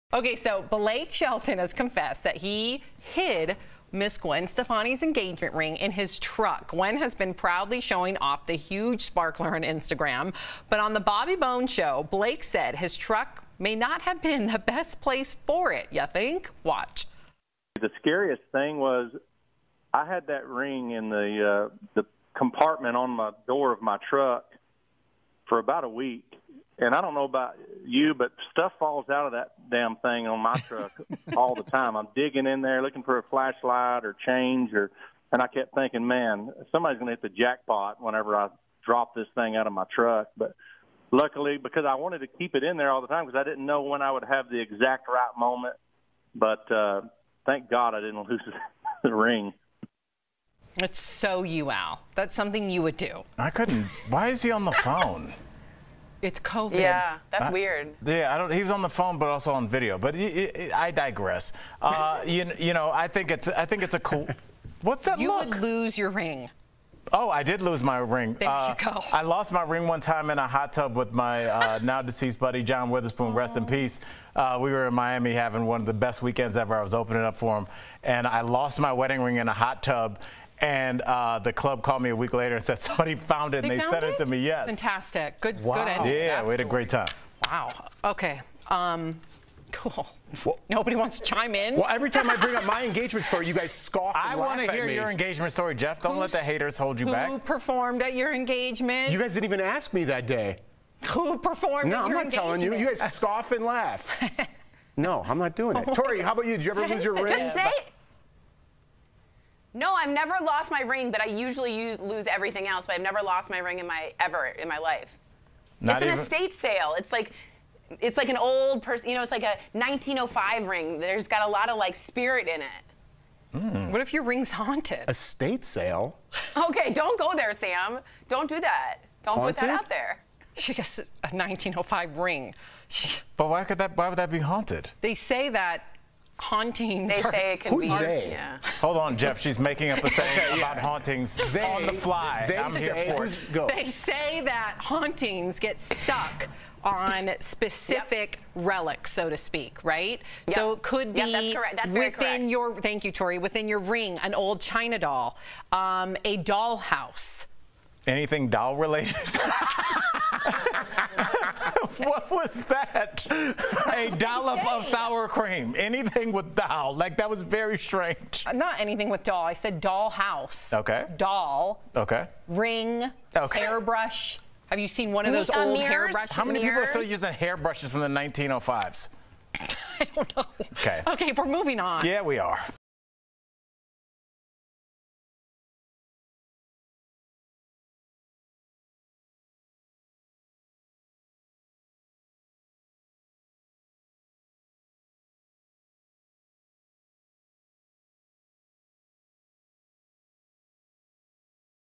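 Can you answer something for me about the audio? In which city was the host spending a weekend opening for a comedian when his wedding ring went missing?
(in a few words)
Miami.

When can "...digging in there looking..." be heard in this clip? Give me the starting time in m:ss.
0:32.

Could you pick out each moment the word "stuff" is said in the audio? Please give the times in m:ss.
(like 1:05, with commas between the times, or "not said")
0:28.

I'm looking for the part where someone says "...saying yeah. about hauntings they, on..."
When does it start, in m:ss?
2:20.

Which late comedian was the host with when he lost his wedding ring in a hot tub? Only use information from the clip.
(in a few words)
John Witherspoon.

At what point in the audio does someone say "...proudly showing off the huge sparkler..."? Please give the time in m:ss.
0:07.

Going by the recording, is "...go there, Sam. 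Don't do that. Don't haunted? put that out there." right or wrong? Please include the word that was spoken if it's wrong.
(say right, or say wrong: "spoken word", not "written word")
right.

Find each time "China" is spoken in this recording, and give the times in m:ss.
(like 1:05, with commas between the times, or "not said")
2:34.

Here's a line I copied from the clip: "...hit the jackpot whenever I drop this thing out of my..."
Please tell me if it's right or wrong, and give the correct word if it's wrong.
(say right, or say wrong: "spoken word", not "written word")
right.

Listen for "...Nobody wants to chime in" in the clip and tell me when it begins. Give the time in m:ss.
1:30.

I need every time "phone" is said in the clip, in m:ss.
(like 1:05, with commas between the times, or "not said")
0:54, 0:58.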